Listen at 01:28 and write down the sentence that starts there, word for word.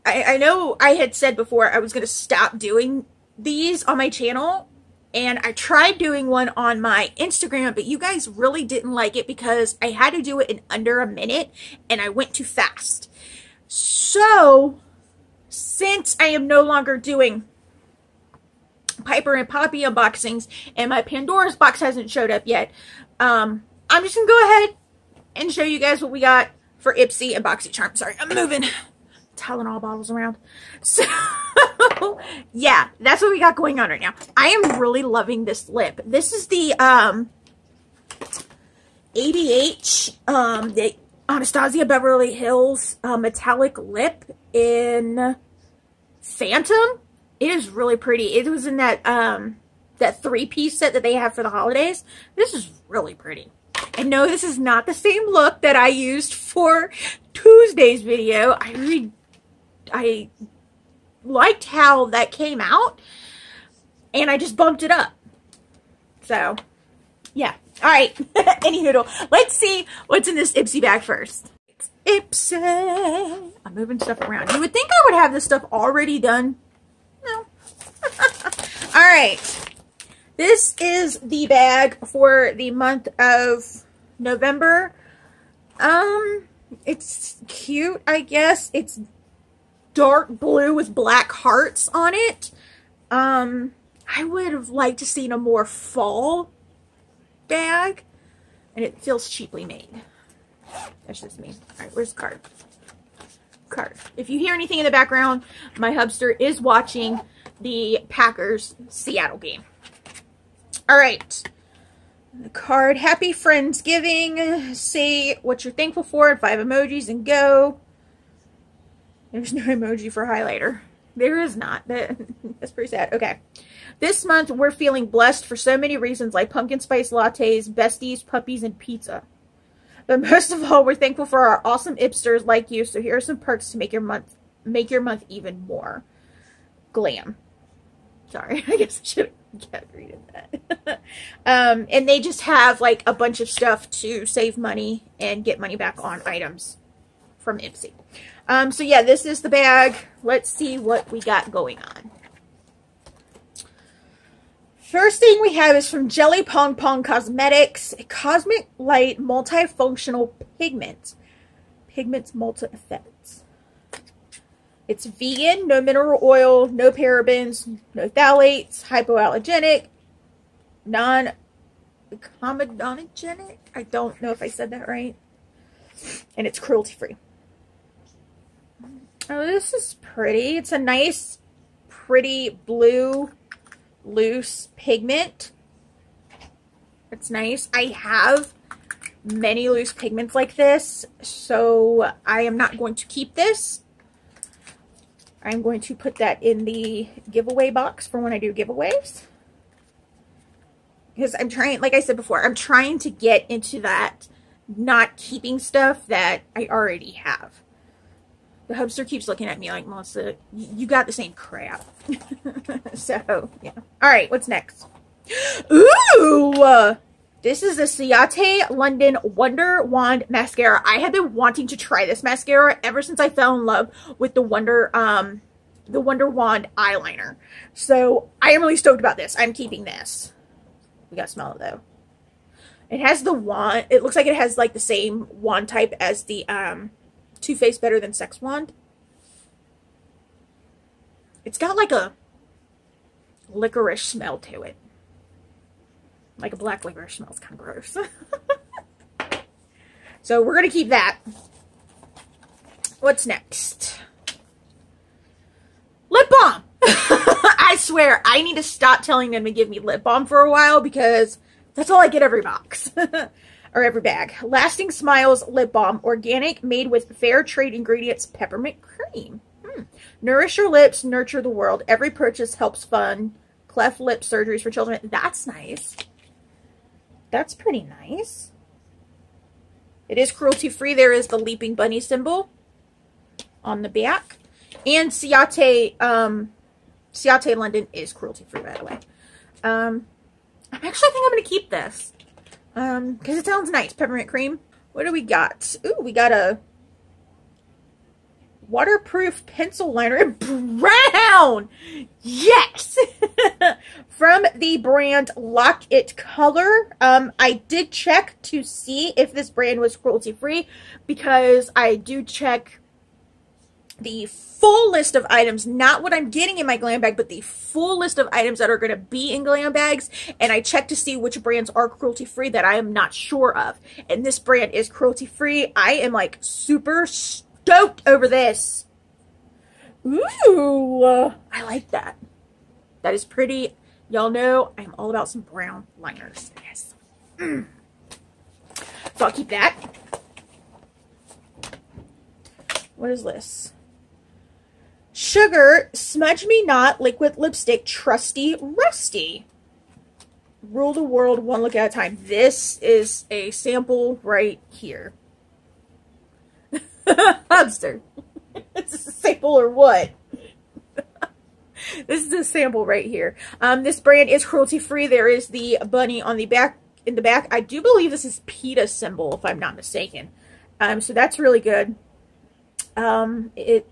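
It's dark blue with black hearts on it.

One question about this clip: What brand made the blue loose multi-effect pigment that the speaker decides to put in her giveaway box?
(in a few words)
Jelly Pong Pong.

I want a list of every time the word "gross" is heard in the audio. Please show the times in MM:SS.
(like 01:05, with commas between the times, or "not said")
04:07.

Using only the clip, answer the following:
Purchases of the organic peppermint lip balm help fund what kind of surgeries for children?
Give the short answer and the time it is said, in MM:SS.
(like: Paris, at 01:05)
cleft lip surgeries, at 04:33.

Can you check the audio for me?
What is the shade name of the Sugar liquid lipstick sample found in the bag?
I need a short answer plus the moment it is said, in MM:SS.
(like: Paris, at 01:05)
Trusty Rusty, at 05:47.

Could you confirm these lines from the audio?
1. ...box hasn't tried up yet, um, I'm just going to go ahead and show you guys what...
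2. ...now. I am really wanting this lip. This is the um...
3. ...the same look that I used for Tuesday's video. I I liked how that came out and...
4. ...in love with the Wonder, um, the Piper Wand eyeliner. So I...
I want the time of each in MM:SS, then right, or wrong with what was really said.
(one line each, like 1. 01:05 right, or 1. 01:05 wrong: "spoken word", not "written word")
1. 00:21 wrong: "showed", not "tried"
2. 00:34 wrong: "loving", not "wanting"
3. 00:54 right
4. 03:43 wrong: "Wonder", not "Piper".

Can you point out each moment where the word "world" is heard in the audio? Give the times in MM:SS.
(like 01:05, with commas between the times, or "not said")
04:31, 05:51.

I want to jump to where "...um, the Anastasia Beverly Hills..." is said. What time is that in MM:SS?
00:40.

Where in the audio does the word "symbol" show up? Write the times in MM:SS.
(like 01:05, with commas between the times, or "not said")
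04:42, 06:08.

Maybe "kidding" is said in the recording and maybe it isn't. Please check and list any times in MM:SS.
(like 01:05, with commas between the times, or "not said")
not said.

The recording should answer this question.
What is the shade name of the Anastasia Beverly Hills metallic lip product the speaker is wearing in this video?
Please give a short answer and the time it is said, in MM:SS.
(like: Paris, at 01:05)
Phantom, at 00:46.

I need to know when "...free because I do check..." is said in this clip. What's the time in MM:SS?
05:10.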